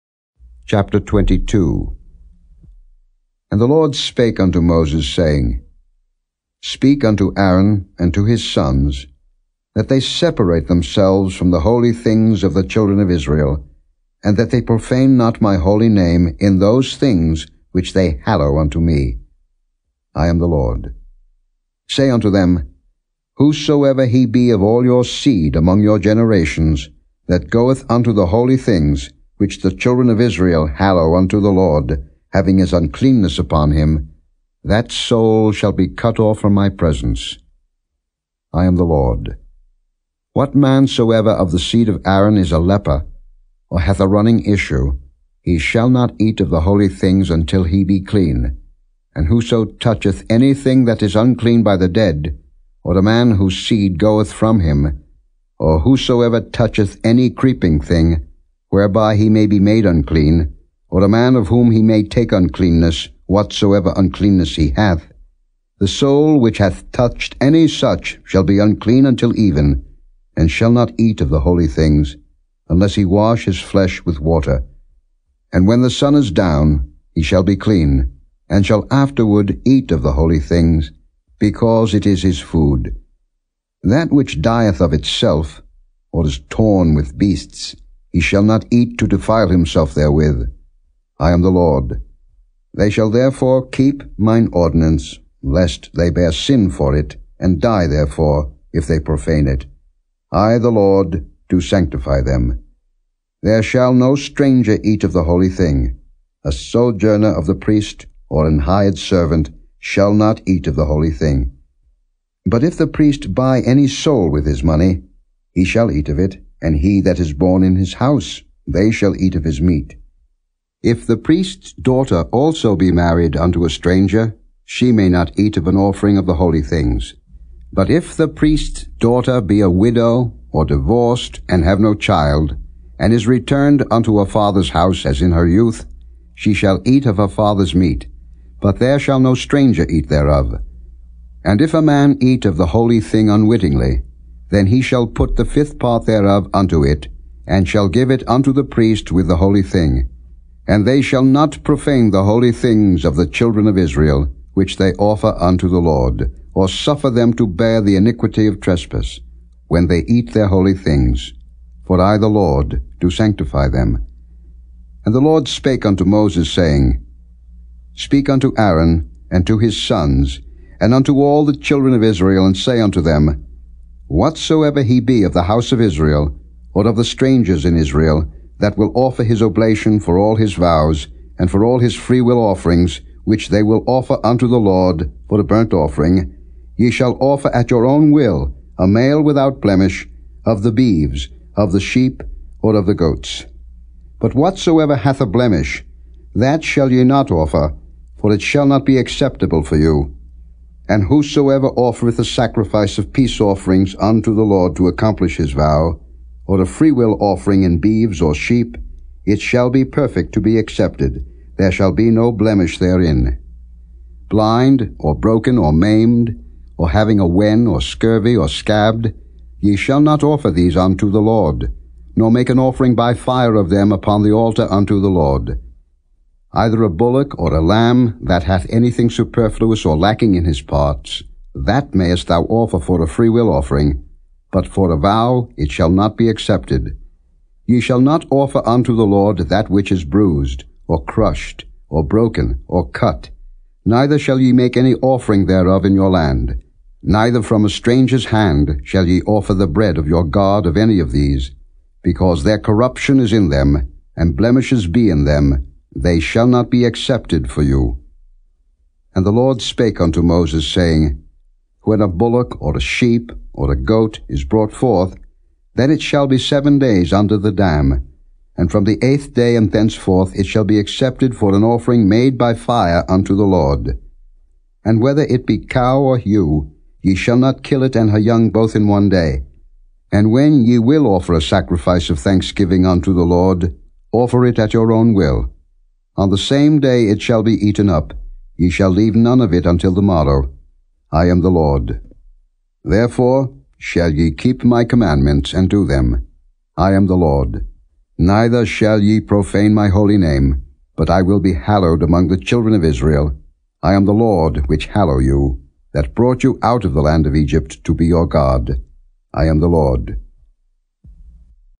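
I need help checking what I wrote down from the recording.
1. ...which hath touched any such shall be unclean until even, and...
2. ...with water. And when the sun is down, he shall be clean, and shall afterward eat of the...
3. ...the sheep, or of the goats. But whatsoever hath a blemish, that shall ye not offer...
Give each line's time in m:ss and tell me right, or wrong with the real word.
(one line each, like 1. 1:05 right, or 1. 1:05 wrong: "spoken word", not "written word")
1. 1:06 right
2. 1:14 right
3. 3:11 right.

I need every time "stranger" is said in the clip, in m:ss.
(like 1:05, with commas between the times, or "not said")
1:44, 2:03, 2:19, 2:57, 4:07.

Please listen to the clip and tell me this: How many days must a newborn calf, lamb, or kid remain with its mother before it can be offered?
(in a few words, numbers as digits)
7 days.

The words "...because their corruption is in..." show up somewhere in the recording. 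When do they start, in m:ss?
4:12.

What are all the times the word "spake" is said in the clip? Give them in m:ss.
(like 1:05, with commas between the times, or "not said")
0:03, 2:45, 4:19.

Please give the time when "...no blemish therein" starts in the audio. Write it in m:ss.
3:32.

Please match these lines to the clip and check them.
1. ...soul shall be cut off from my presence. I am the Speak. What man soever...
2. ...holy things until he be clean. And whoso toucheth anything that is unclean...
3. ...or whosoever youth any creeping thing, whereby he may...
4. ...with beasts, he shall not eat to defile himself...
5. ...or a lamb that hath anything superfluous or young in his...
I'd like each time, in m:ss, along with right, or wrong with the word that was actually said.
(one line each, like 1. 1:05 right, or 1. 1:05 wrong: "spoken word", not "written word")
1. 0:34 wrong: "Lord", not "Speak"
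2. 0:46 right
3. 0:55 wrong: "toucheth", not "youth"
4. 1:26 right
5. 3:47 wrong: "lacking", not "young".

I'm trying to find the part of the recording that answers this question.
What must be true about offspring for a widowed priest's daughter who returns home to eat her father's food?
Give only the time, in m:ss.
2:11.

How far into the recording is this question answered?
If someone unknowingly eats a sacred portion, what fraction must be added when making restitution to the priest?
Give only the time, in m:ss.
2:25.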